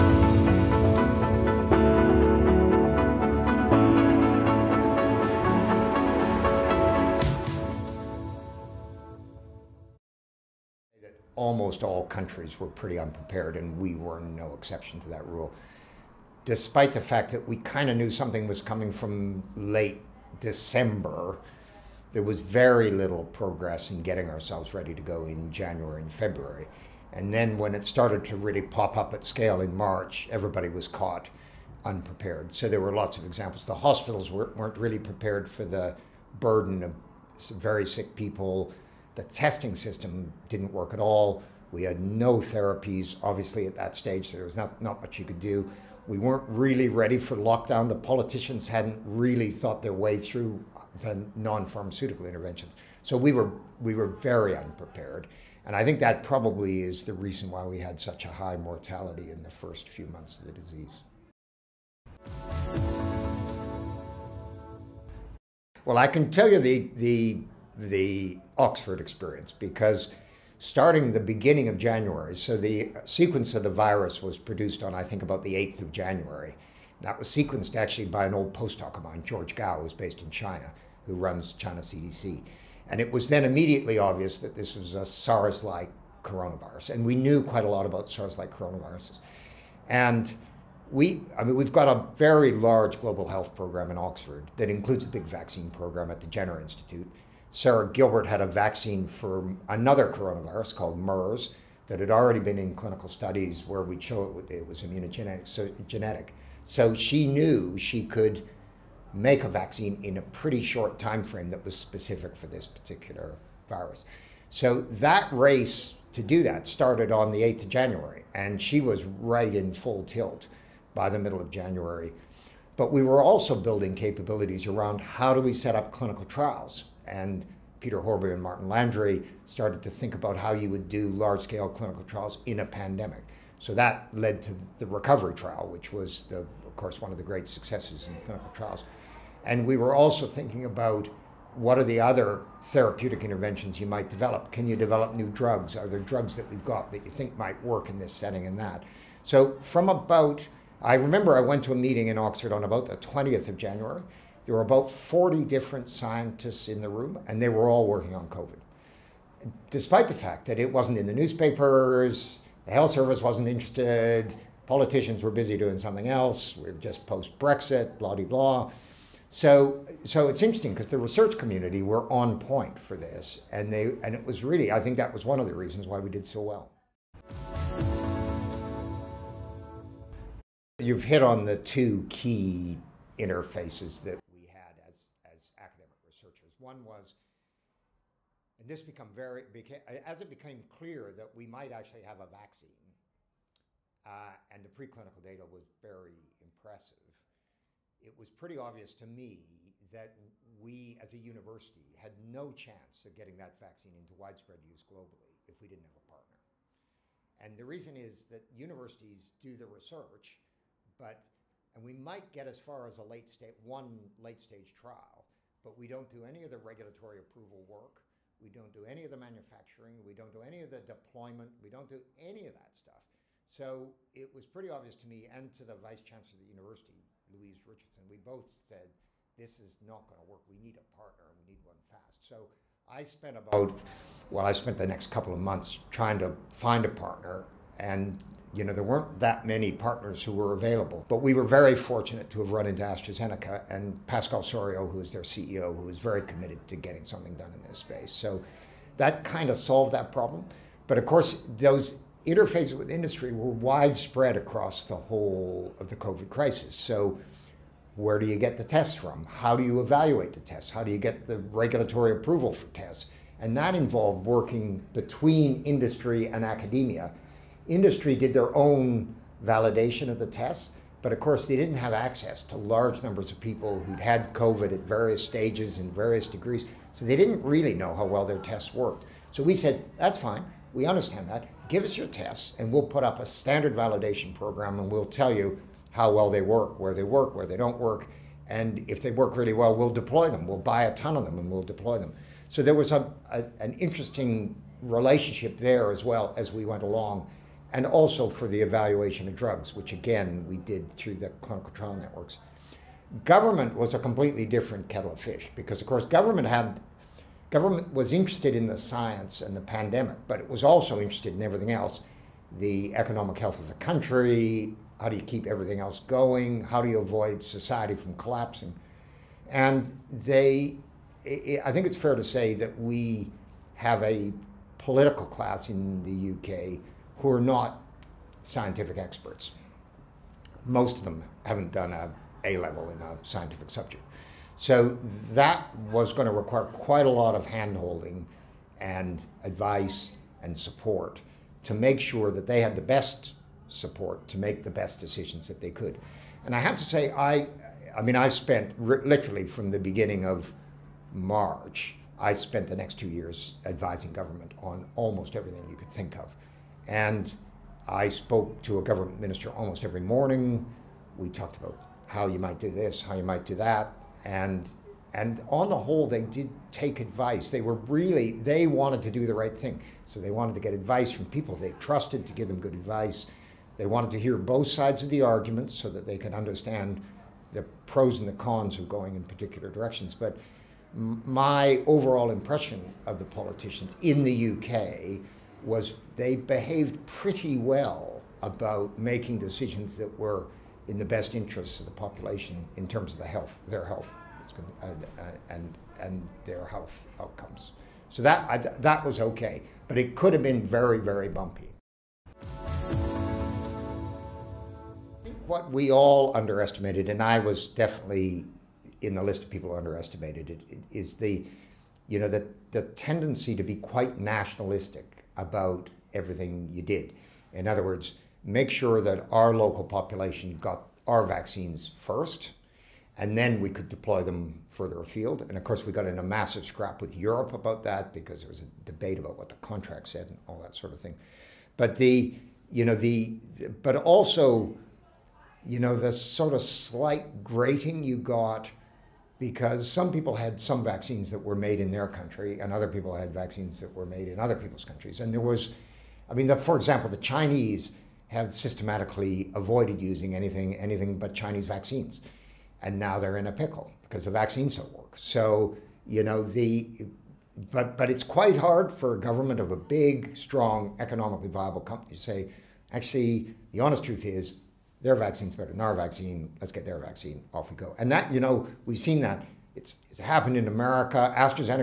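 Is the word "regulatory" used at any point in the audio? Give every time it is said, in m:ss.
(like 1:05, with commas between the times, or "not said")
3:36, 4:21.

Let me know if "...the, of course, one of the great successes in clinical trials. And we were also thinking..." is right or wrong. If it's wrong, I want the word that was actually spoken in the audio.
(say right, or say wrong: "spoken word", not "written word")
right.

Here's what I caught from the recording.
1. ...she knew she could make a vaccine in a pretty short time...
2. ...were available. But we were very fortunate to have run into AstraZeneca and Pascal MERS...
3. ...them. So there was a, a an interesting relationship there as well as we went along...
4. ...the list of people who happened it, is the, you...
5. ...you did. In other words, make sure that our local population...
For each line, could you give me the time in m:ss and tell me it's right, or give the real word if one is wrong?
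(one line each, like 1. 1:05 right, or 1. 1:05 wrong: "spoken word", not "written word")
1. 1:46 right
2. 4:00 wrong: "Soriot", not "MERS"
3. 4:51 right
4. 6:49 wrong: "underestimated", not "happened"
5. 6:56 right.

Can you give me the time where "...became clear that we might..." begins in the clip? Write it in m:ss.
3:10.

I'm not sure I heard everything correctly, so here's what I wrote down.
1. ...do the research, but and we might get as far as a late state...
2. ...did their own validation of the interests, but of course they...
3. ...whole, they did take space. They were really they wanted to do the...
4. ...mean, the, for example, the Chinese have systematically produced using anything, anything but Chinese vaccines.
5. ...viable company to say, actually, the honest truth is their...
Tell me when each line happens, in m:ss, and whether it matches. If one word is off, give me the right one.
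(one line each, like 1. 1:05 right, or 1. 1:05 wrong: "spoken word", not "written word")
1. 3:29 right
2. 4:28 wrong: "tests", not "interests"
3. 6:05 wrong: "advice", not "space"
4. 7:26 wrong: "avoided", not "produced"
5. 7:41 right.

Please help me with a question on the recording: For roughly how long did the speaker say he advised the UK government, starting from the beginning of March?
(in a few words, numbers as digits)
2 years.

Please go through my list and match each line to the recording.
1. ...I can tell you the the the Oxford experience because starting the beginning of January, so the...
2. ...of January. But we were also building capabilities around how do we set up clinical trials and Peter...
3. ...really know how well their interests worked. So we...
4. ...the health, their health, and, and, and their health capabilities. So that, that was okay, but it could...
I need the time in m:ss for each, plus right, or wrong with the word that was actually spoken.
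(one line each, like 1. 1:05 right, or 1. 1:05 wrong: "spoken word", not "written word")
1. 1:05 right
2. 2:01 right
3. 4:37 wrong: "tests", not "interests"
4. 6:33 wrong: "outcomes", not "capabilities".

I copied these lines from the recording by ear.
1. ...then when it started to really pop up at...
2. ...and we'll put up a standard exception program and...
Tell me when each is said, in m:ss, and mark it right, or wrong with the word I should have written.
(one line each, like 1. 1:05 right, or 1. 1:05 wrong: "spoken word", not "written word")
1. 0:27 right
2. 4:42 wrong: "validation", not "exception".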